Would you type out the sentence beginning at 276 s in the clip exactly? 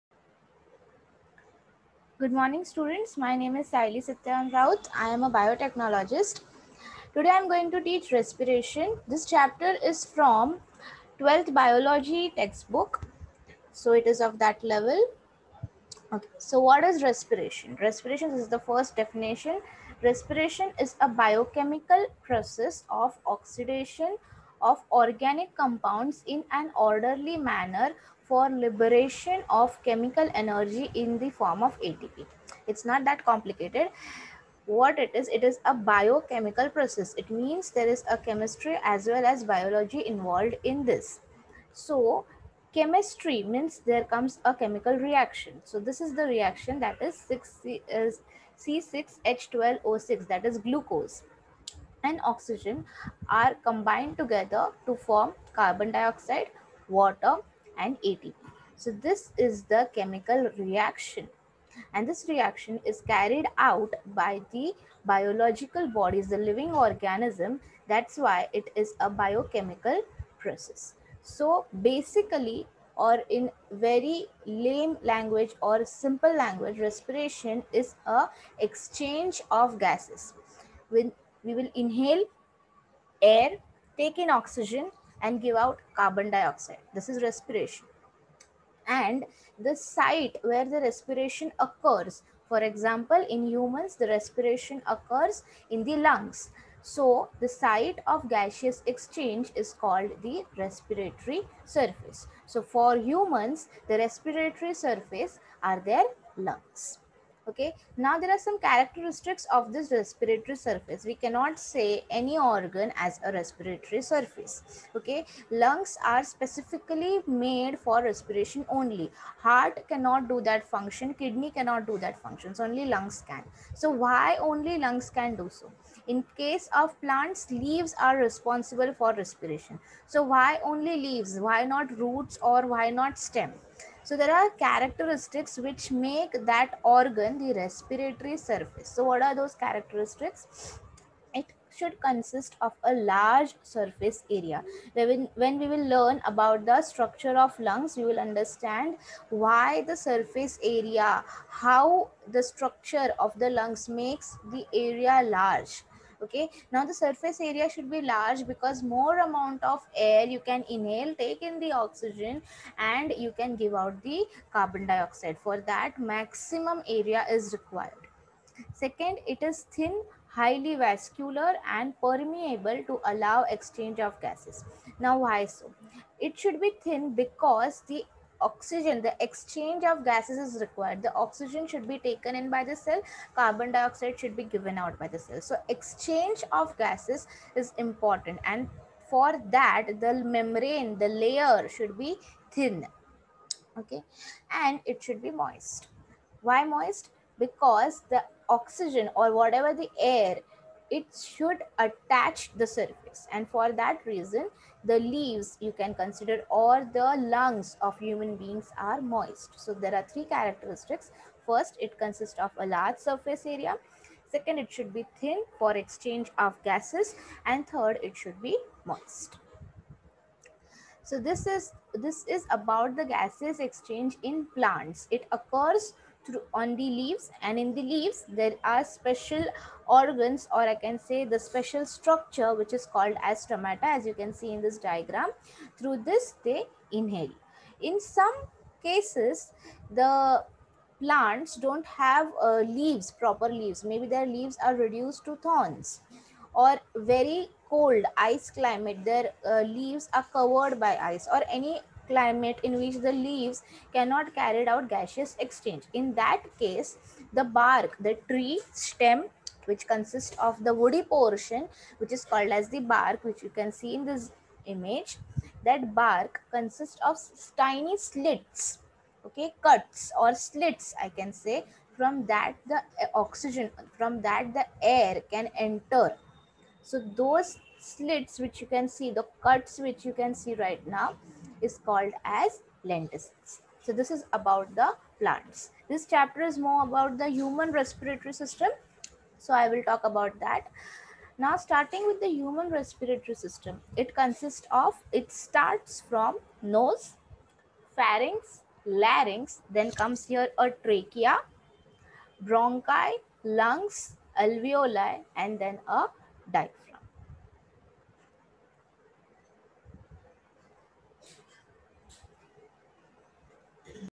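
So those slits which you can see, the cuts which you can see right now, is called as lenticels.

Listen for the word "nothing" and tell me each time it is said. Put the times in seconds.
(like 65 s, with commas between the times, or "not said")
not said.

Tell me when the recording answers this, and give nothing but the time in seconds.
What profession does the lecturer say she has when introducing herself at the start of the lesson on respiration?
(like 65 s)
5 s.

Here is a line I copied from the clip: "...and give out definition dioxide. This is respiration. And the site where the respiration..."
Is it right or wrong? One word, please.
wrong.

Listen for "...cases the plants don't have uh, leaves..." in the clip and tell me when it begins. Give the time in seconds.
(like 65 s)
238 s.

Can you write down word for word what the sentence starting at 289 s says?
So I will talk about that.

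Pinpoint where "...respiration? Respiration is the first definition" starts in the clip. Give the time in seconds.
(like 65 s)
17 s.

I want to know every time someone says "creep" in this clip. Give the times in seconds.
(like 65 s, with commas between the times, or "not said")
not said.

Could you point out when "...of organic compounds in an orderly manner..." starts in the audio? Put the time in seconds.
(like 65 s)
24 s.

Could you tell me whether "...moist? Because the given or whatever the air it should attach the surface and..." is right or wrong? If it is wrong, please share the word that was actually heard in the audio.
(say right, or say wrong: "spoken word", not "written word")
wrong: "oxygen", not "given".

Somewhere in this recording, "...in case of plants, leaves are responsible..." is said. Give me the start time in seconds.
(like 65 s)
126 s.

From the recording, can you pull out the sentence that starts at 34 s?
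What it is, it is a biochemical process.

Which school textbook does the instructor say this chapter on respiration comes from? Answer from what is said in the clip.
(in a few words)
12th biology textbook.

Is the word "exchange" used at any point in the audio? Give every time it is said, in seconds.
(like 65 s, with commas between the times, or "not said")
78 s, 98 s, 173 s, 179 s, 185 s, 215 s, 223 s, 255 s.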